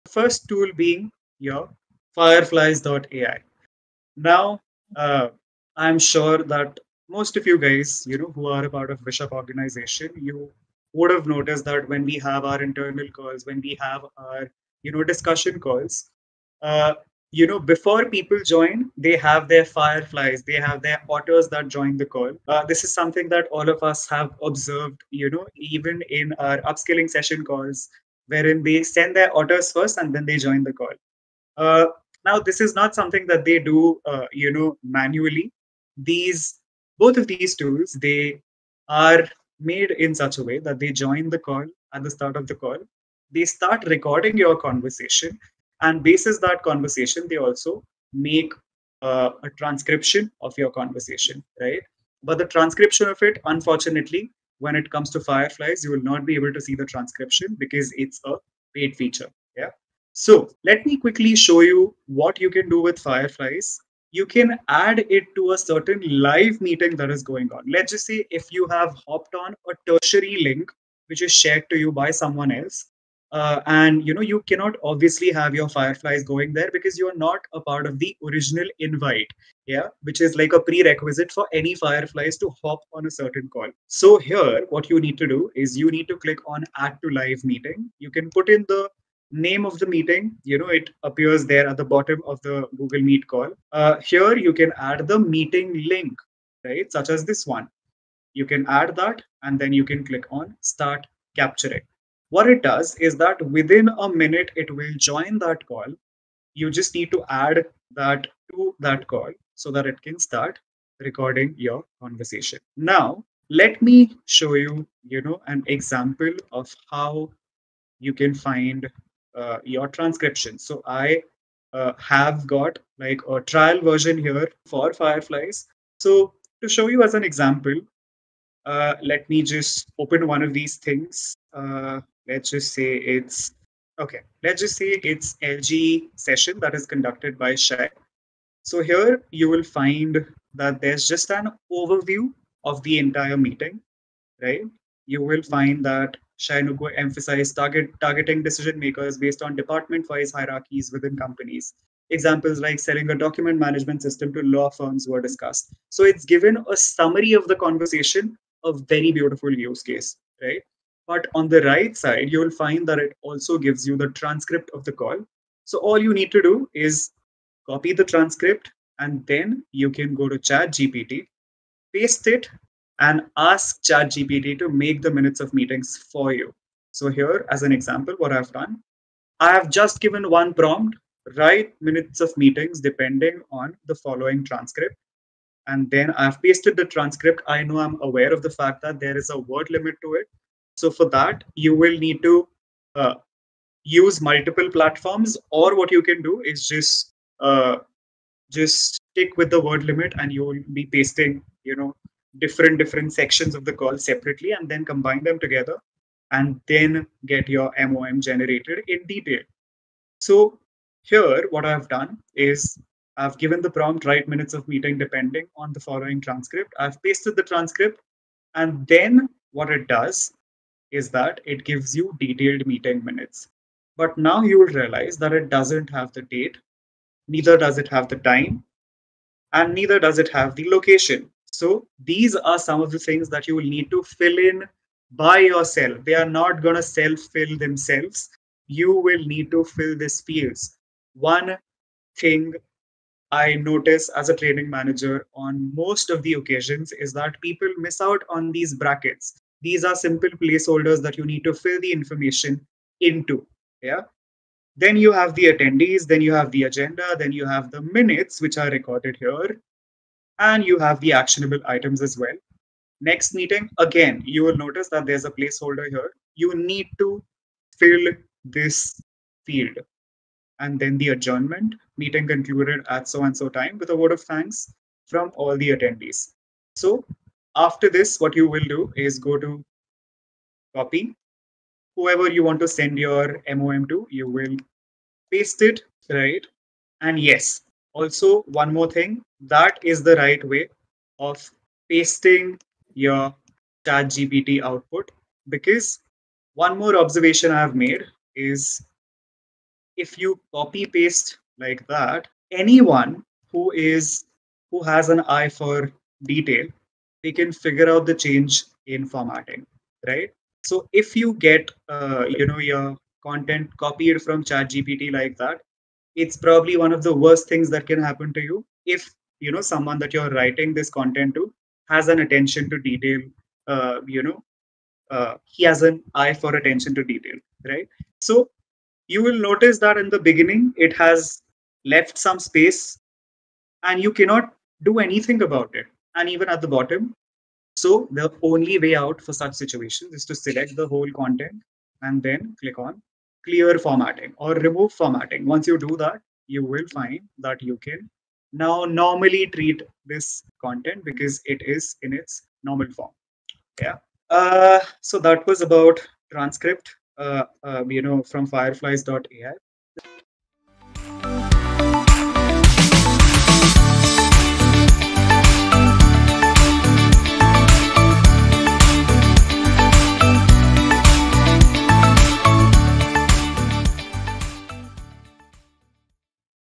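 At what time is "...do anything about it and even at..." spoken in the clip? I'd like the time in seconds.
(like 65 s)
334 s.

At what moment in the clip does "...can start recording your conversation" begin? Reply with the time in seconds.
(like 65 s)
110 s.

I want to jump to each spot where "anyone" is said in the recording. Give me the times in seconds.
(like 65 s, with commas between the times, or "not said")
302 s.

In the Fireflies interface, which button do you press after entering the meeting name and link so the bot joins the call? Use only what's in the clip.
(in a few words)
Start capturing.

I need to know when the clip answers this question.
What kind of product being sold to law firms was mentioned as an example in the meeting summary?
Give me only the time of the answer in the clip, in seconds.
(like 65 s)
153 s.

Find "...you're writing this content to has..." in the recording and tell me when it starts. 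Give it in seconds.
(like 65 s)
320 s.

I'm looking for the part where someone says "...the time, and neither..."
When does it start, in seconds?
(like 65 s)
228 s.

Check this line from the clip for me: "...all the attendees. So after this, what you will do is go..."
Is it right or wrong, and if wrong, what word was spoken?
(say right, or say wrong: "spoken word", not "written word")
right.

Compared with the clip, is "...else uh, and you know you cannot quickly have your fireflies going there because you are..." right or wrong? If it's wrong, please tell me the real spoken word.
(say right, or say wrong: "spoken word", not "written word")
wrong: "obviously", not "quickly".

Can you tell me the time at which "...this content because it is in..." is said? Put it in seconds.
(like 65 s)
350 s.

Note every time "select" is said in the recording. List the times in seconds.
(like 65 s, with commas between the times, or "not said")
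340 s.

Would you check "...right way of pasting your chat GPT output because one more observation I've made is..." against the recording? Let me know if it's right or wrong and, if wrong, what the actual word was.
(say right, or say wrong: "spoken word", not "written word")
right.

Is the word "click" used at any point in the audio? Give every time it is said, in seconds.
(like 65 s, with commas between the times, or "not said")
86 s, 100 s, 342 s.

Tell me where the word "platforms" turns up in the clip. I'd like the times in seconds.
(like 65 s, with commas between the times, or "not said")
194 s.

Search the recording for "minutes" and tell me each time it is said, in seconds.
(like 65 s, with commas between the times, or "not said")
104 s, 175 s, 181 s, 214 s, 223 s, 257 s.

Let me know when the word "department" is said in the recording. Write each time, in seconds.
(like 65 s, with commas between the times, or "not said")
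149 s.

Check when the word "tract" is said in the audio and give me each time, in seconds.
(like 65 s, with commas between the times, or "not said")
not said.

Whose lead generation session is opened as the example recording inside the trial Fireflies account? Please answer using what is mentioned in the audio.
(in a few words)
Shai.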